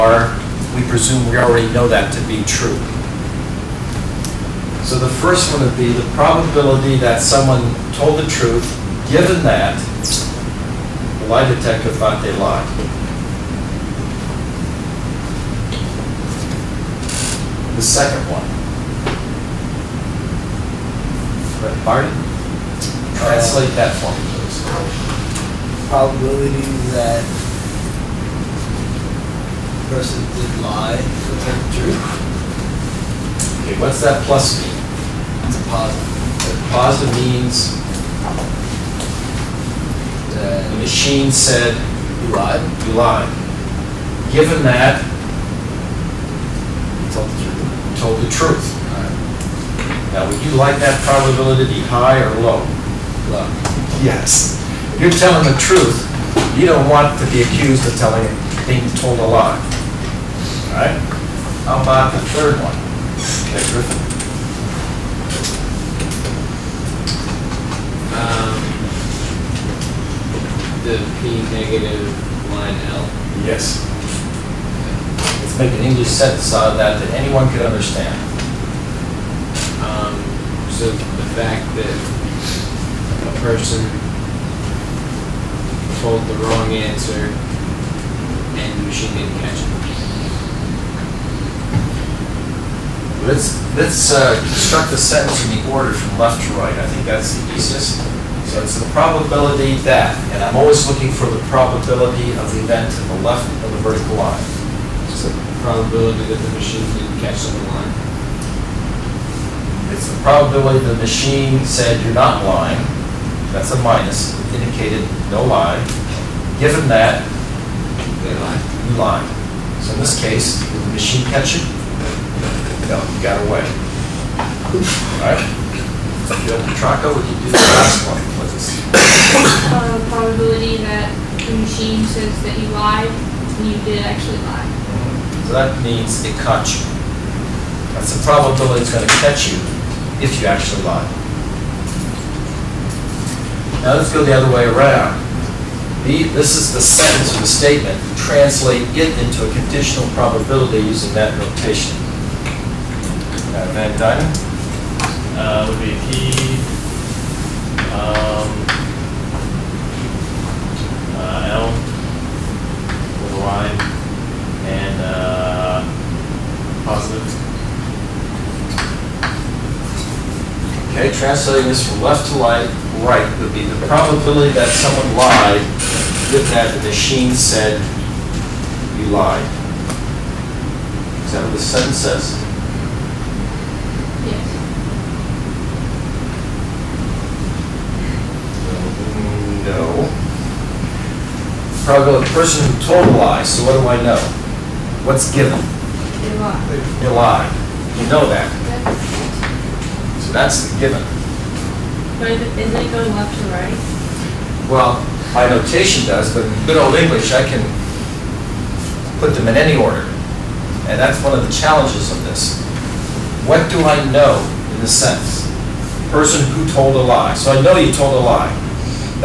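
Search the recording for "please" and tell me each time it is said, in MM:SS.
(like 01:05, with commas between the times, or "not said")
00:24, 02:08.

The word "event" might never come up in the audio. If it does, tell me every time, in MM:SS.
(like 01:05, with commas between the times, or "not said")
01:42.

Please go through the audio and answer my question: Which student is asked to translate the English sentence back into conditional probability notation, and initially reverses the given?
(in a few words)
Van Dyne.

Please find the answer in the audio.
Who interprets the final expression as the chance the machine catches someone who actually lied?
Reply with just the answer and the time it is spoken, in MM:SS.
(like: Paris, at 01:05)
Bill Petracco, at 02:06.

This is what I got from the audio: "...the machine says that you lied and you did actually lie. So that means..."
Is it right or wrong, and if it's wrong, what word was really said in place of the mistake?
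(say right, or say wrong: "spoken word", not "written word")
right.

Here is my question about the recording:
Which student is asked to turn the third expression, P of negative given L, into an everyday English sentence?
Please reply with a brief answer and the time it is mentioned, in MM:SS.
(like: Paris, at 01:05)
Griffin, at 01:03.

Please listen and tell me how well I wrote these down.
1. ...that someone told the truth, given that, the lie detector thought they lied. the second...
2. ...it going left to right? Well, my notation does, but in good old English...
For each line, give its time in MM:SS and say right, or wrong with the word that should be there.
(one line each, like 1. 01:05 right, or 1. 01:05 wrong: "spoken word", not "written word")
1. 00:06 right
2. 03:22 right.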